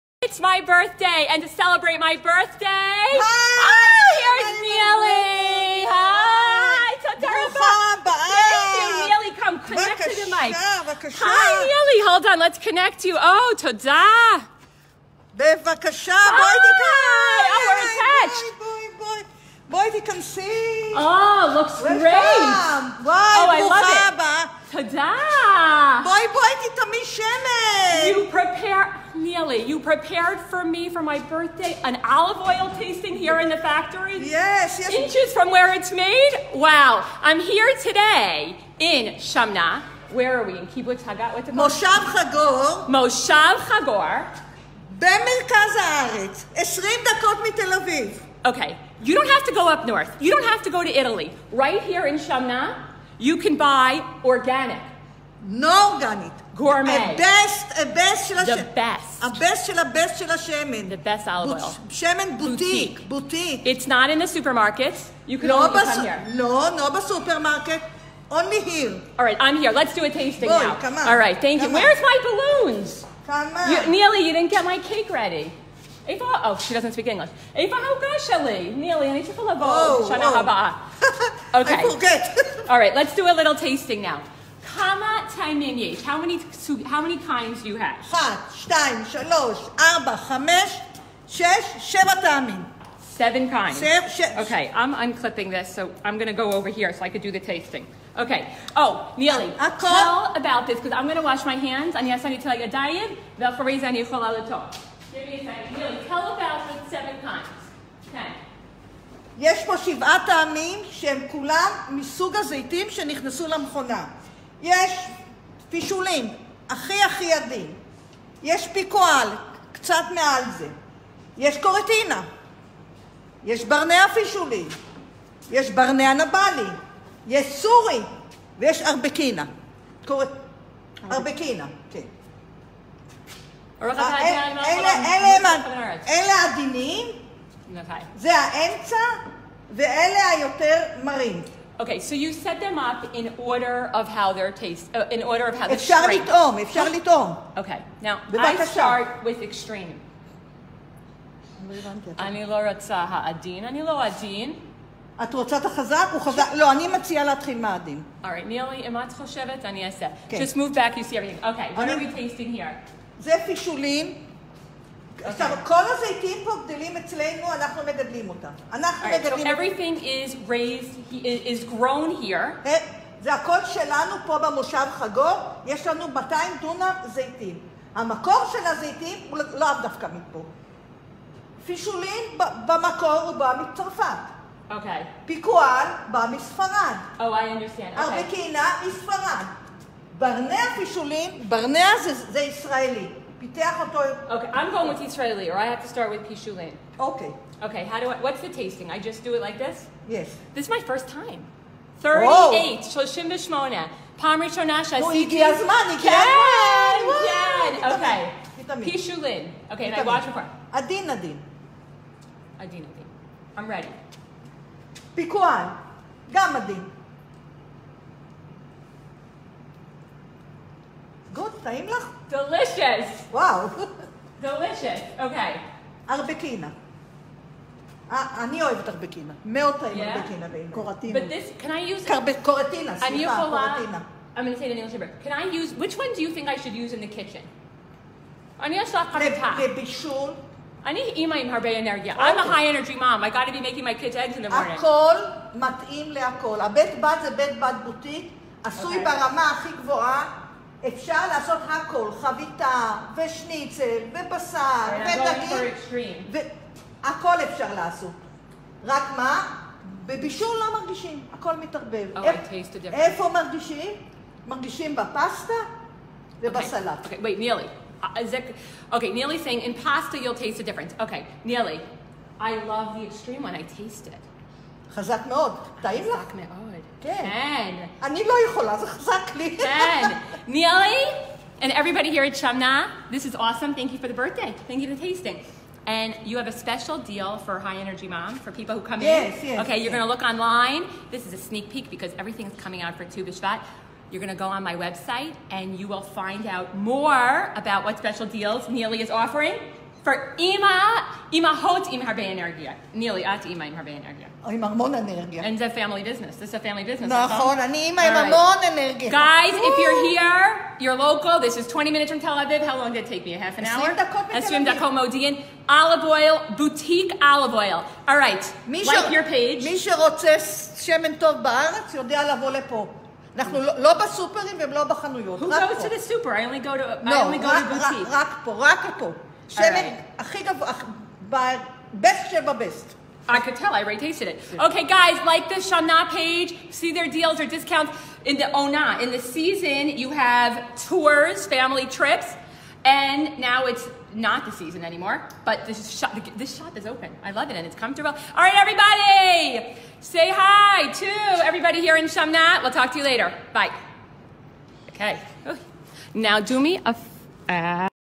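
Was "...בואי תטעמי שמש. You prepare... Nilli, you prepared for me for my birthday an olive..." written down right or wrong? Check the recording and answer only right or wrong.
right.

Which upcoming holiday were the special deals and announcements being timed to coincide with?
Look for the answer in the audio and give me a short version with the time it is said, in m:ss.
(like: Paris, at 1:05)
Tu B'Shvat, at 4:53.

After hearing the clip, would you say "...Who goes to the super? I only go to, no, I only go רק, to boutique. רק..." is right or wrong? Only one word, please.
right.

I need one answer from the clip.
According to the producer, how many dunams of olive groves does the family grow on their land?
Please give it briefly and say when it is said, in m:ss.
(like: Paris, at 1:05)
200, at 2:56.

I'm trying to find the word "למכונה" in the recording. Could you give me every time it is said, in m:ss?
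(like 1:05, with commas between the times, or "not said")
1:53.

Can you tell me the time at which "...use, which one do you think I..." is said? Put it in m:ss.
3:55.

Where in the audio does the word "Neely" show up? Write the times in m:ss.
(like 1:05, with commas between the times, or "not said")
1:39, 1:45.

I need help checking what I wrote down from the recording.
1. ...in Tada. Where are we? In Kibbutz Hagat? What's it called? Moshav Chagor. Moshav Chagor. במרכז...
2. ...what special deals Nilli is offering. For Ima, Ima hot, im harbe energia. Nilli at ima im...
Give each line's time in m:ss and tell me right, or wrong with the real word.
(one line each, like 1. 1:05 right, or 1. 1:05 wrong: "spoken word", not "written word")
1. 0:38 wrong: "Shamna", not "Tada"
2. 4:57 right.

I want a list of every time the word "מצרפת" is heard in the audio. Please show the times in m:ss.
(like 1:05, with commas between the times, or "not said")
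3:03.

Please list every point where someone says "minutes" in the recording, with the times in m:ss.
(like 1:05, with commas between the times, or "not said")
5:11.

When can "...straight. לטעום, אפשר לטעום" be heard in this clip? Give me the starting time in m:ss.
2:26.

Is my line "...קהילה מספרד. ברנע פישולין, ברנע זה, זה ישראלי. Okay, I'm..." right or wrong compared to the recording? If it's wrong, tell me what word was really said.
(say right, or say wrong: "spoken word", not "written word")
right.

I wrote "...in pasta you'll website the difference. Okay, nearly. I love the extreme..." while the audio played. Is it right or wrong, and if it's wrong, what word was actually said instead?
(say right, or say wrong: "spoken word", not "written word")
wrong: "taste", not "website".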